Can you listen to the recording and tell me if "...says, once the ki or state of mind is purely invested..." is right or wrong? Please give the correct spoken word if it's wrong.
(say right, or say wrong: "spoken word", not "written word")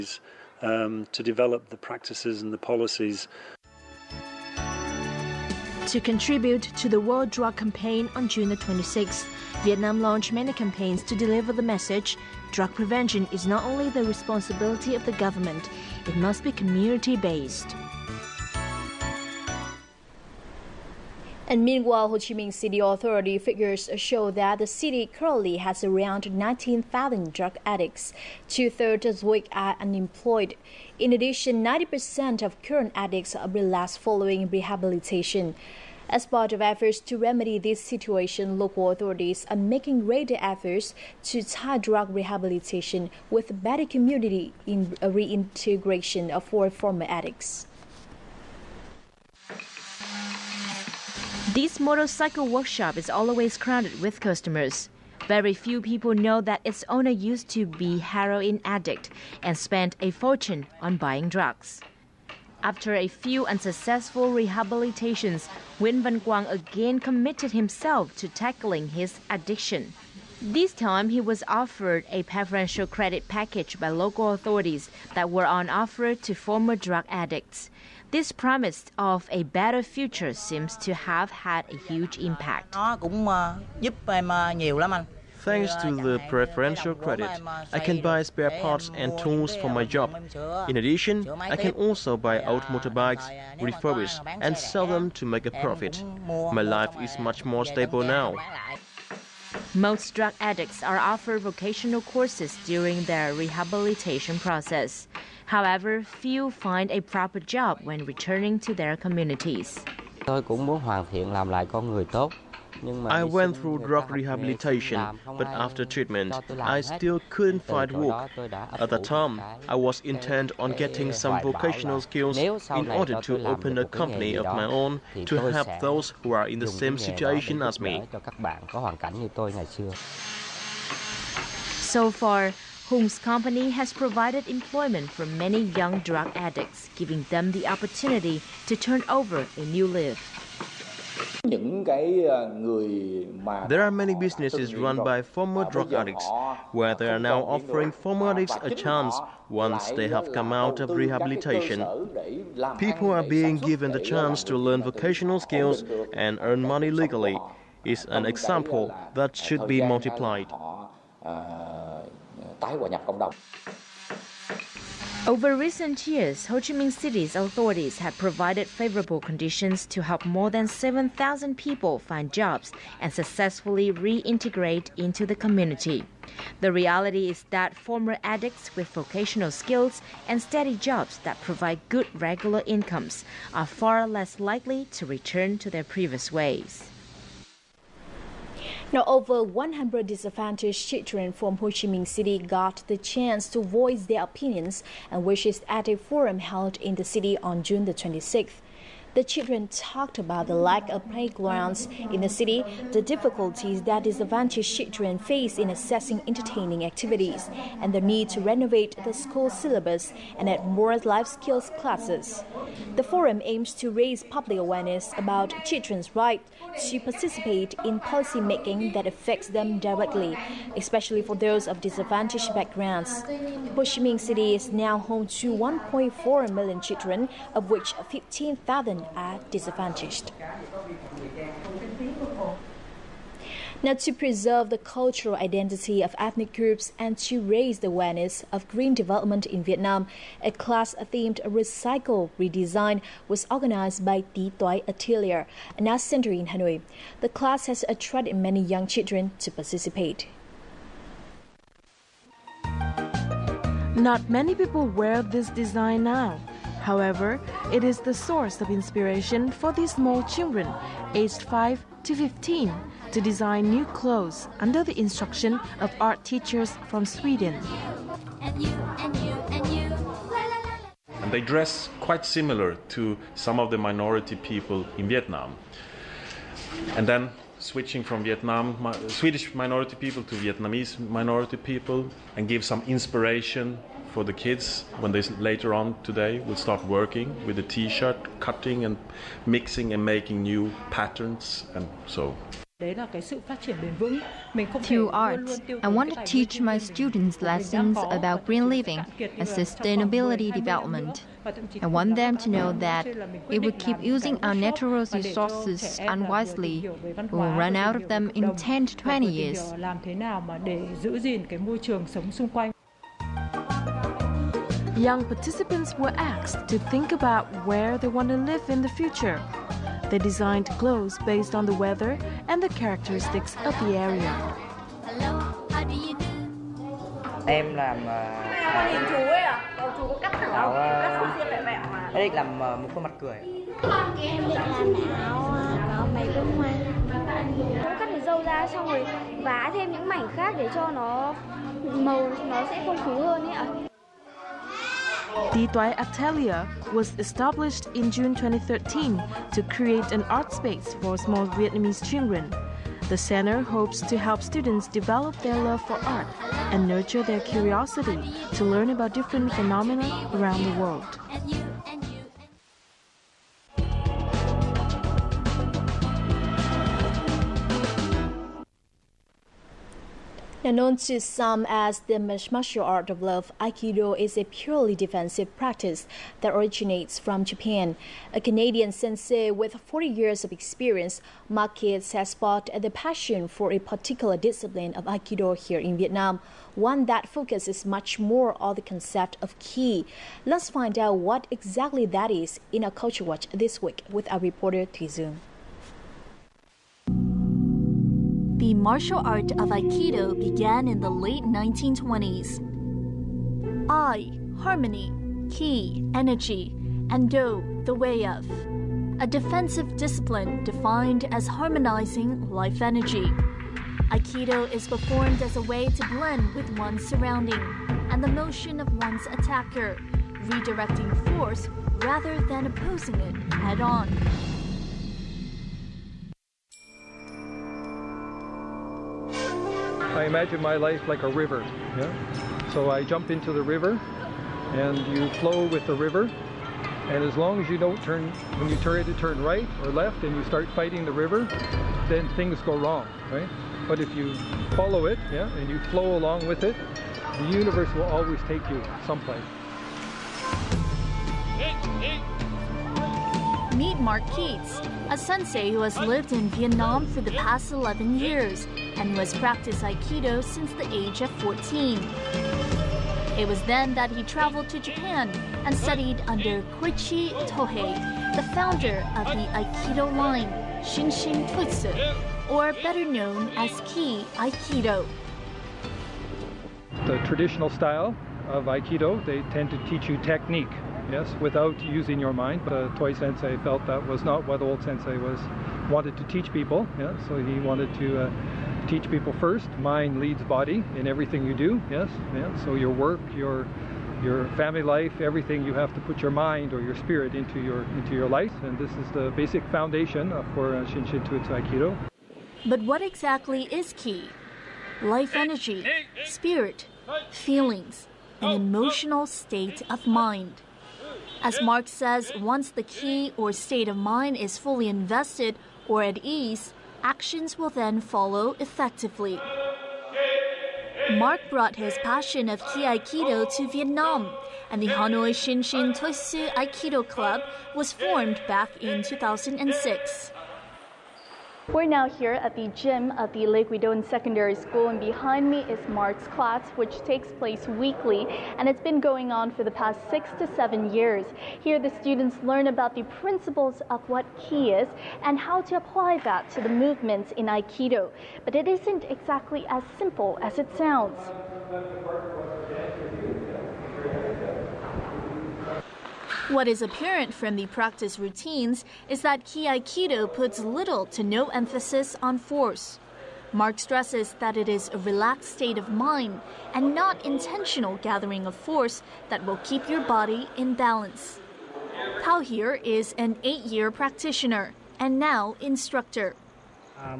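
wrong: "fully", not "purely".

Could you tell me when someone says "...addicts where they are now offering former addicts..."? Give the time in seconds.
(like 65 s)
145 s.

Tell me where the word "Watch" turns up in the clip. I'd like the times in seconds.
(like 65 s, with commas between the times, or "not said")
393 s.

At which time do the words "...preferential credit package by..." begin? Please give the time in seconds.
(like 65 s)
72 s.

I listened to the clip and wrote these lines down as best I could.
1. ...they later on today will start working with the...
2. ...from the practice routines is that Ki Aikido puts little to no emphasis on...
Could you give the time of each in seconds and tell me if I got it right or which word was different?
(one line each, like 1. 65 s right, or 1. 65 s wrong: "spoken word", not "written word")
1. 285 s right
2. 557 s right.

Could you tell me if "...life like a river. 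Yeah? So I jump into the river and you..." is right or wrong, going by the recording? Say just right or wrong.
right.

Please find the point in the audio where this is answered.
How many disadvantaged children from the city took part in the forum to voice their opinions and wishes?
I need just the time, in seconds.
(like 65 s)
189 s.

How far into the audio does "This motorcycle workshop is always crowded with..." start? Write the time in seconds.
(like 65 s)
51 s.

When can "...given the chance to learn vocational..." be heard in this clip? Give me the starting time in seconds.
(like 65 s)
153 s.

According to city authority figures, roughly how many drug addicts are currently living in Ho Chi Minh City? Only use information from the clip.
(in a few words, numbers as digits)
19,000.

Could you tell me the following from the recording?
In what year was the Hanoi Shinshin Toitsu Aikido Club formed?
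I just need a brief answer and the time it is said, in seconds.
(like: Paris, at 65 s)
2006, at 529 s.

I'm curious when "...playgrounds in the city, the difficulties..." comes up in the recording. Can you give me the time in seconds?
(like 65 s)
201 s.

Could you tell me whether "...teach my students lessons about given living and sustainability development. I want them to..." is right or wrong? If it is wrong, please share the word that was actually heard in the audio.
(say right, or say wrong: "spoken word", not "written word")
wrong: "green", not "given".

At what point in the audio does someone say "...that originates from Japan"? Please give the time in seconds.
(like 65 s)
376 s.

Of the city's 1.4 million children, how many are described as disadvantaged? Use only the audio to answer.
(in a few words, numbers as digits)
15,000.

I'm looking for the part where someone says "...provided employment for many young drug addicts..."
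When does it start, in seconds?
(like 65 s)
133 s.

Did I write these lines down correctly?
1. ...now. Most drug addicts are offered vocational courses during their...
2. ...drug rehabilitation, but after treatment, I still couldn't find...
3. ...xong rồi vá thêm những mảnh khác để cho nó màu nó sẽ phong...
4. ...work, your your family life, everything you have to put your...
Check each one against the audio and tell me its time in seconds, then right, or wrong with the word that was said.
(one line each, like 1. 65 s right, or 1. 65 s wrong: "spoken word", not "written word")
1. 98 s right
2. 113 s right
3. 338 s right
4. 492 s right.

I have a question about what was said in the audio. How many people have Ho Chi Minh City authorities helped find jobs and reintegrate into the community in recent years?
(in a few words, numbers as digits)
7,000.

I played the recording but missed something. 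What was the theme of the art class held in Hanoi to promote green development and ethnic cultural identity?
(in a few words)
Recycle Redesign.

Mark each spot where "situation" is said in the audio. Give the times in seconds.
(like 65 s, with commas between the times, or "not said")
37 s, 126 s.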